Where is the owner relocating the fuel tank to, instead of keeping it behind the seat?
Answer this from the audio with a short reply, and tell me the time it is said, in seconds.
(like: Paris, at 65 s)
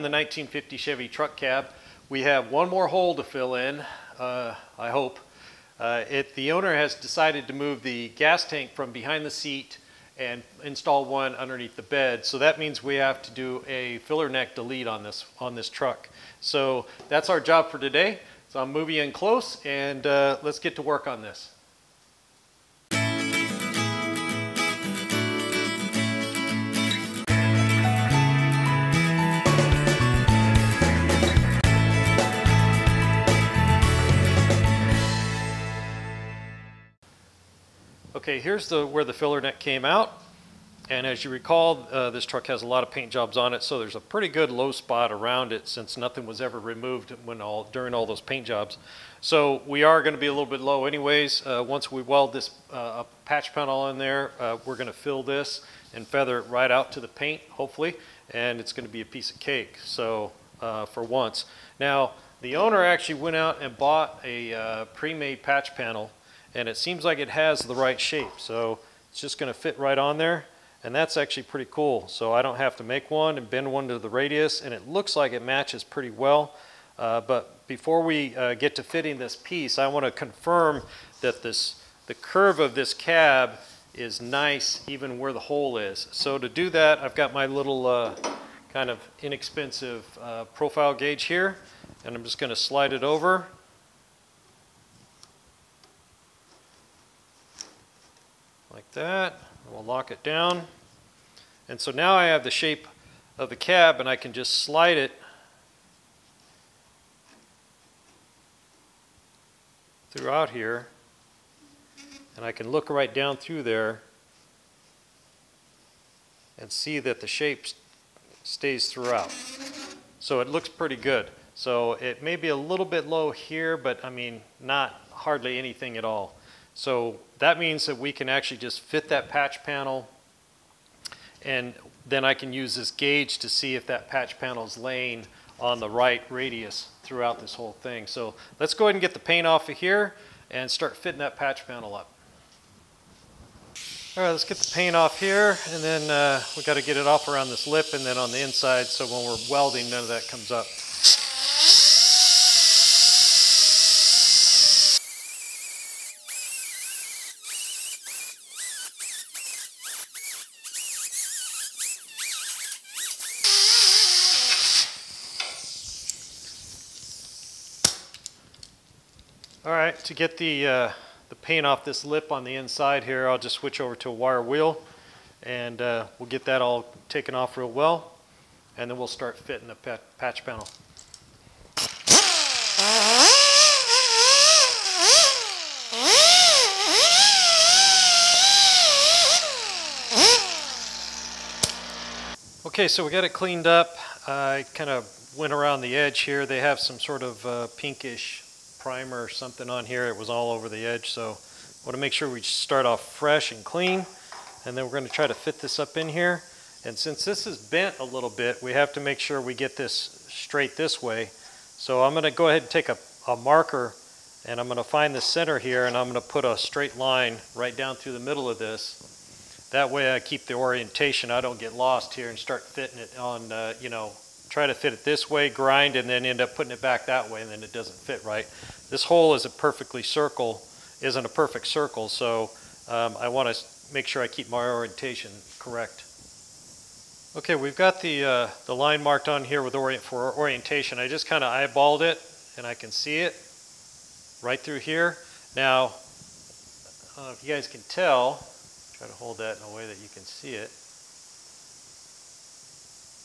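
underneath the bed, at 11 s.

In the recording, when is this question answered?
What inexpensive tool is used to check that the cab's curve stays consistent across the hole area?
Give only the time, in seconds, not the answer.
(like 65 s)
90 s.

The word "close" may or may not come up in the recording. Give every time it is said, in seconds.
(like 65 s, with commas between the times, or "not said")
19 s.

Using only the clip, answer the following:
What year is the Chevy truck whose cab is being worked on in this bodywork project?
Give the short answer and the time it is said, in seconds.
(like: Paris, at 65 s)
1950, at 0 s.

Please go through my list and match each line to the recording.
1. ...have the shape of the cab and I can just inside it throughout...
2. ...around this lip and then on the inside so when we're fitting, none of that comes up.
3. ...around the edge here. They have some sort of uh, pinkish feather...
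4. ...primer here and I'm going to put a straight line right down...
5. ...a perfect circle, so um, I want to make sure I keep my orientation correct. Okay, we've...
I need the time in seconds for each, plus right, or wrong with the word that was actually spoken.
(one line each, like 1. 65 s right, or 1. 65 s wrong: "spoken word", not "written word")
1. 102 s wrong: "slide", not "inside"
2. 147 s wrong: "welding", not "fitting"
3. 195 s wrong: "primer", not "feather"
4. 215 s wrong: "center", not "primer"
5. 231 s right.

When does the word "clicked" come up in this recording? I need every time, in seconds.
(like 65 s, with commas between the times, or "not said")
not said.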